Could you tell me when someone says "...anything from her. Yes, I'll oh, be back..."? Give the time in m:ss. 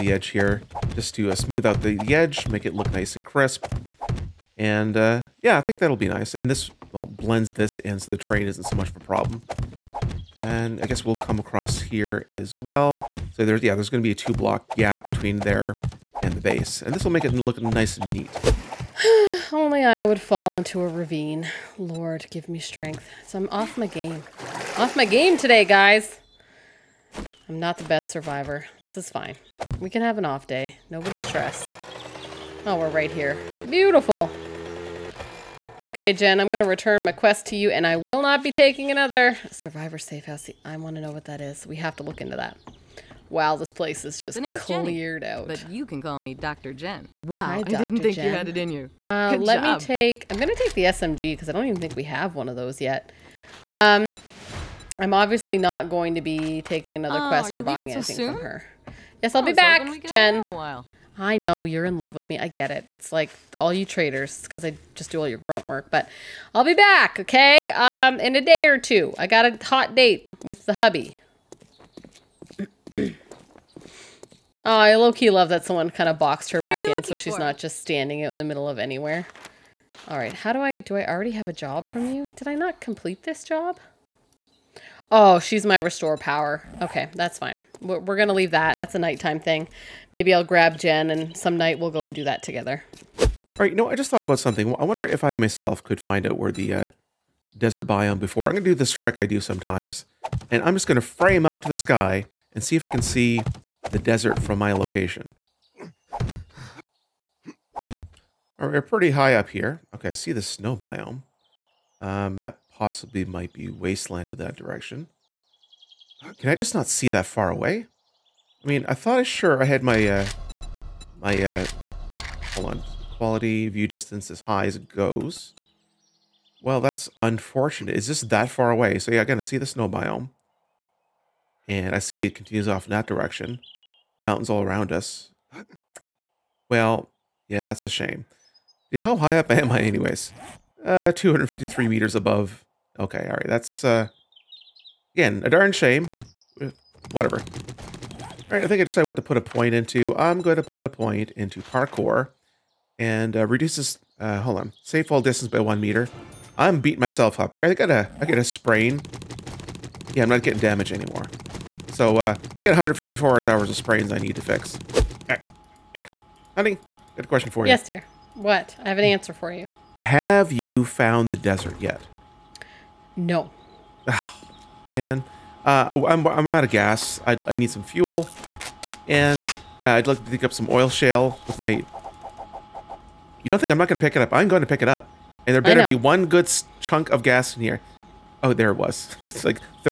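0:57.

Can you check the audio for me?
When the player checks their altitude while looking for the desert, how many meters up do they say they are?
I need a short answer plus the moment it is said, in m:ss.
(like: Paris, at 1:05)
253, at 2:21.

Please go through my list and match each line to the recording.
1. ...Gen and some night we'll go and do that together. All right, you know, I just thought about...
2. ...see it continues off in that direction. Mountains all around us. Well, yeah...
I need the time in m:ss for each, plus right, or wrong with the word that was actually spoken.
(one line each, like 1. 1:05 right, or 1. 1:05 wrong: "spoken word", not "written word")
1. 1:30 right
2. 2:11 right.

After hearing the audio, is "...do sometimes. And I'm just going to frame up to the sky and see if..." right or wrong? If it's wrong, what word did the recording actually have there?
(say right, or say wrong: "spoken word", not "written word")
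right.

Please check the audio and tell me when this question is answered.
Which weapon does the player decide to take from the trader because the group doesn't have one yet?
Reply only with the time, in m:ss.
0:50.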